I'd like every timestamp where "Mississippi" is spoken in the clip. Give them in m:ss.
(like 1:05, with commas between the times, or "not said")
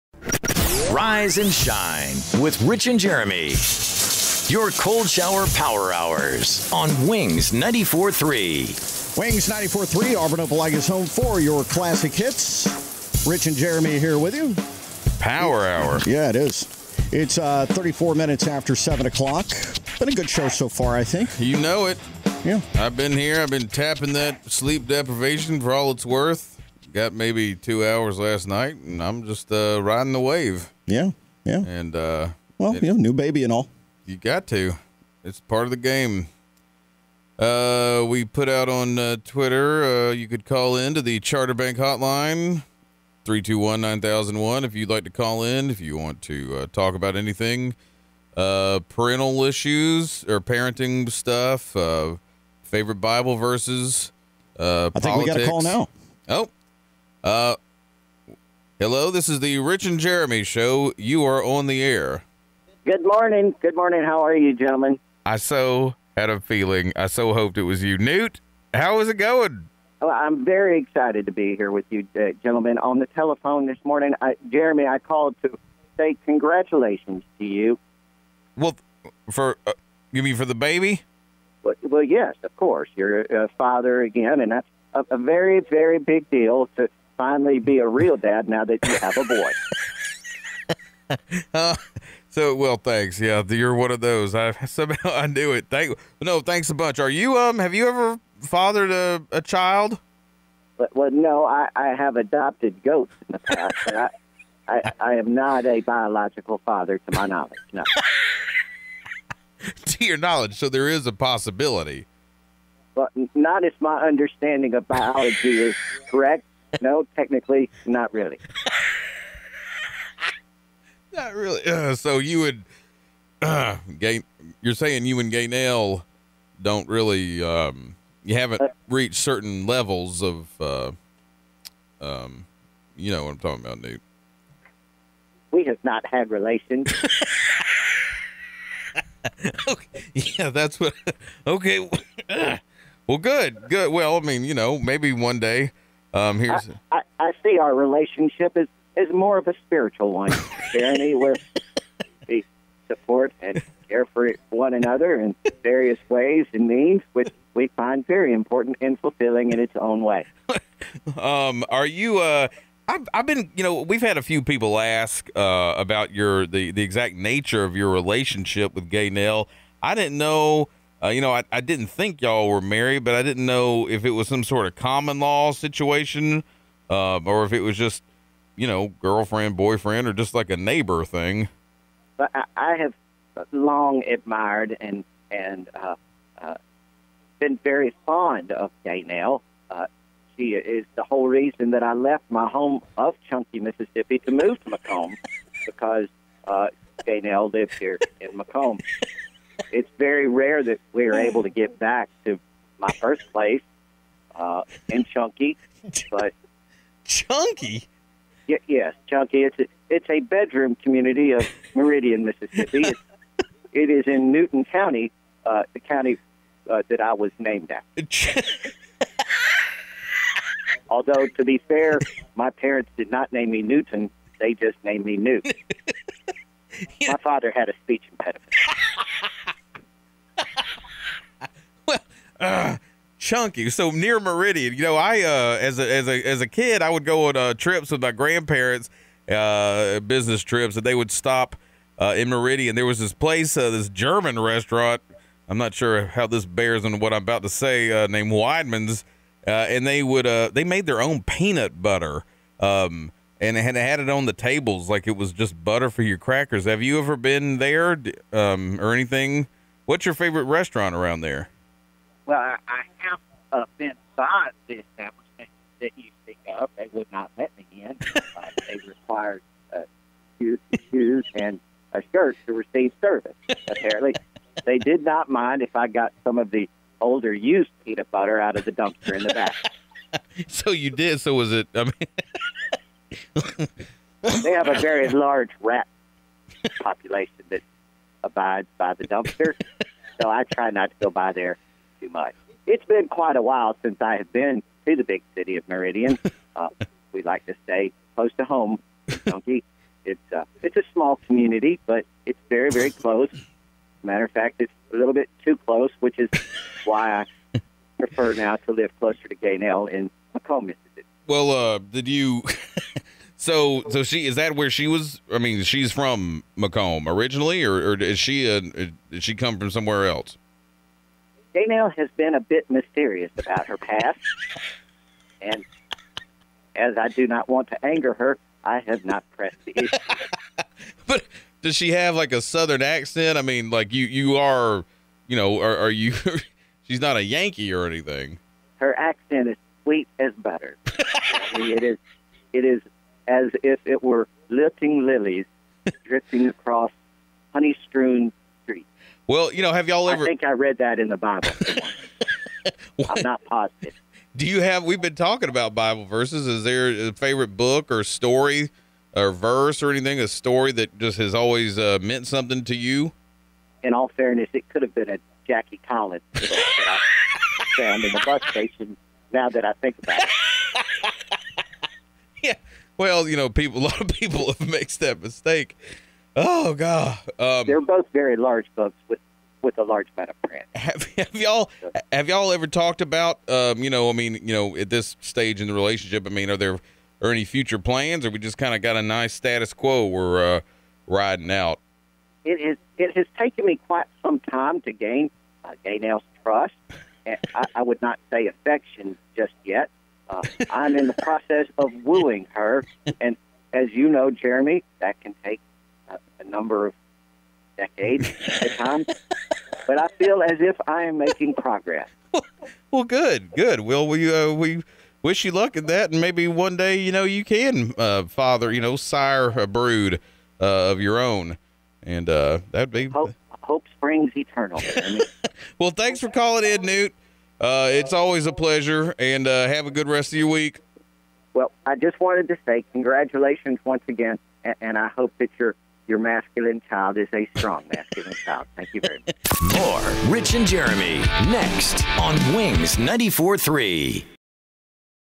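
3:13, 3:32, 5:10.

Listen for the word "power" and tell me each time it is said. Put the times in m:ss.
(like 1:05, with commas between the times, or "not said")
0:05, 0:15.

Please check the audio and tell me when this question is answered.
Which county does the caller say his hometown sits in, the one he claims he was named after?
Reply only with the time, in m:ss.
3:34.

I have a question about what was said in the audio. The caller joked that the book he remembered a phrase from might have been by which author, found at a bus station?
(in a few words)
Jackie Collins.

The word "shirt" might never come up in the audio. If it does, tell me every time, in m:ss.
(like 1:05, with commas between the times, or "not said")
4:32.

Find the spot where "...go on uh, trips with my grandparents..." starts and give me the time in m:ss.
3:57.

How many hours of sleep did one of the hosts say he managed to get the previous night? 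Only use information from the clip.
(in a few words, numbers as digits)
2.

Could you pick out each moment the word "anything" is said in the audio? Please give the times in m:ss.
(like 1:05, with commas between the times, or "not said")
0:47, 4:18, 5:37, 5:59.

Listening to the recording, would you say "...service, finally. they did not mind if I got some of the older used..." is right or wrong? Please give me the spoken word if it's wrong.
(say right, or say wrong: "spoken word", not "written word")
wrong: "apparently", not "finally".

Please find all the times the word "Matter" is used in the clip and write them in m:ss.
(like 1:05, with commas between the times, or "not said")
5:04.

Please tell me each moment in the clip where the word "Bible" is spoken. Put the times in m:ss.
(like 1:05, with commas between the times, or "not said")
0:53, 5:51, 5:55.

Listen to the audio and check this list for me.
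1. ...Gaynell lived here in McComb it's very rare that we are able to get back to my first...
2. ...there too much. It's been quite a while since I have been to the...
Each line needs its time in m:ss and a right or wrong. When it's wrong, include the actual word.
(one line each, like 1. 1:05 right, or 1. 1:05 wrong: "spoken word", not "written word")
1. 3:17 right
2. 4:51 right.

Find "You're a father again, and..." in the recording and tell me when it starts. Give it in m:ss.
1:22.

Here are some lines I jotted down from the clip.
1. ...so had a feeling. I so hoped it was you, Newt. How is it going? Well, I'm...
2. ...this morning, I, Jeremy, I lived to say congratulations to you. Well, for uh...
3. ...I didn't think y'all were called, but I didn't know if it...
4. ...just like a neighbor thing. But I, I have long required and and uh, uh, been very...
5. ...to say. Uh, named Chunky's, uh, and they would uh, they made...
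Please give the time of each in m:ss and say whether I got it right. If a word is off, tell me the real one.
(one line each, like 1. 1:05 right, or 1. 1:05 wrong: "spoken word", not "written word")
1. 1:05 right
2. 1:13 wrong: "called", not "lived"
3. 2:51 wrong: "married", not "called"
4. 3:00 wrong: "admired", not "required"
5. 4:07 wrong: "Weidmann", not "Chunky".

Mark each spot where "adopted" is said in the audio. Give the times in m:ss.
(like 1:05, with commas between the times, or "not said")
1:42.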